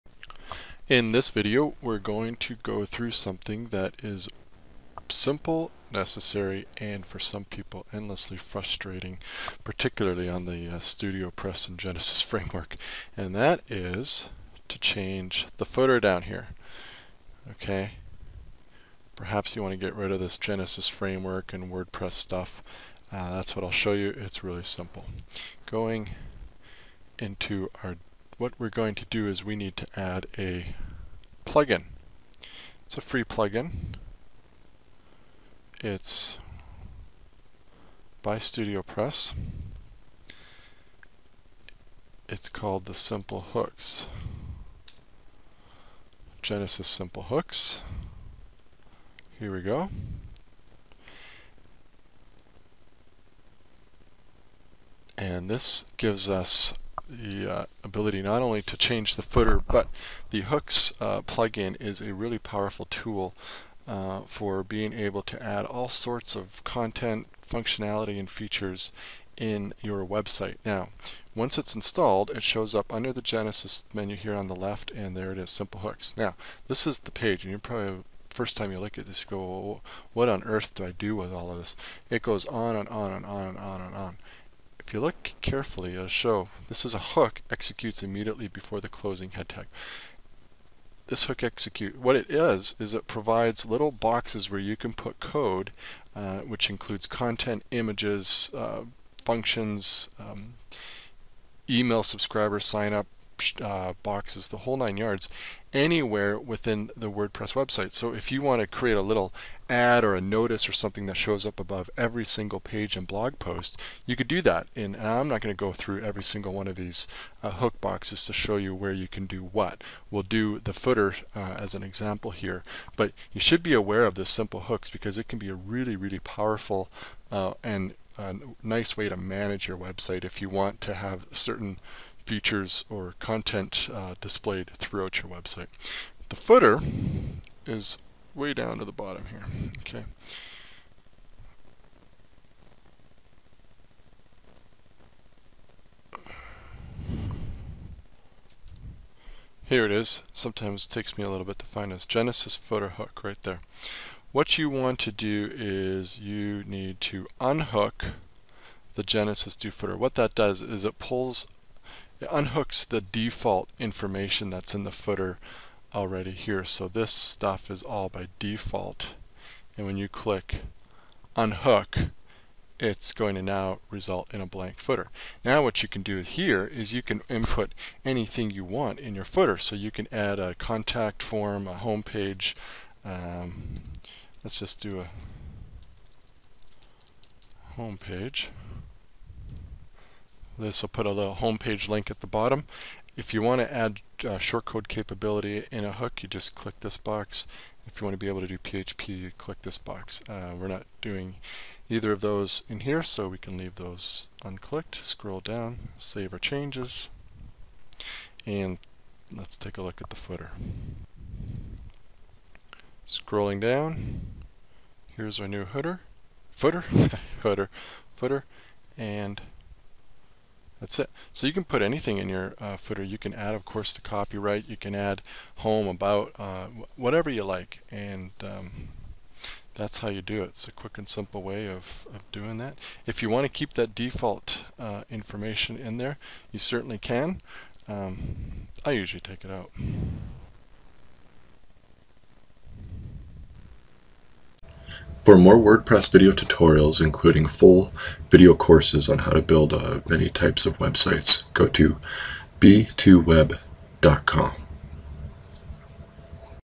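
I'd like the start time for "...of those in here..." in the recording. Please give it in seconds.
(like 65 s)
202 s.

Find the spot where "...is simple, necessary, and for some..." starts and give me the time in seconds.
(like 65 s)
4 s.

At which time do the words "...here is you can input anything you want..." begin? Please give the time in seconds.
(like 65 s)
176 s.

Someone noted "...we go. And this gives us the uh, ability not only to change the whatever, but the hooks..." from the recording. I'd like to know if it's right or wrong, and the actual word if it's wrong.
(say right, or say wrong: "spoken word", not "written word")
wrong: "footer", not "whatever".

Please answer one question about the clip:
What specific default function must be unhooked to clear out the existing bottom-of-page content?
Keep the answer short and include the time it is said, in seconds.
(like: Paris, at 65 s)
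Genesis do footer, at 159 s.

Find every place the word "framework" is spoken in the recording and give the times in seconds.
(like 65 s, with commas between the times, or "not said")
12 s, 20 s.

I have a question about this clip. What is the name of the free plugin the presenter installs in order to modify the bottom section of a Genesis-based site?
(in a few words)
Genesis Simple Hooks.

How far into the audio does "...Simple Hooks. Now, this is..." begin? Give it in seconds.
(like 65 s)
75 s.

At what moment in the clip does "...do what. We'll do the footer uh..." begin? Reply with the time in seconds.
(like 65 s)
119 s.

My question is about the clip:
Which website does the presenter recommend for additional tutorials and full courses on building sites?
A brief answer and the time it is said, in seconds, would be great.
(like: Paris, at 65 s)
b2web.com, at 252 s.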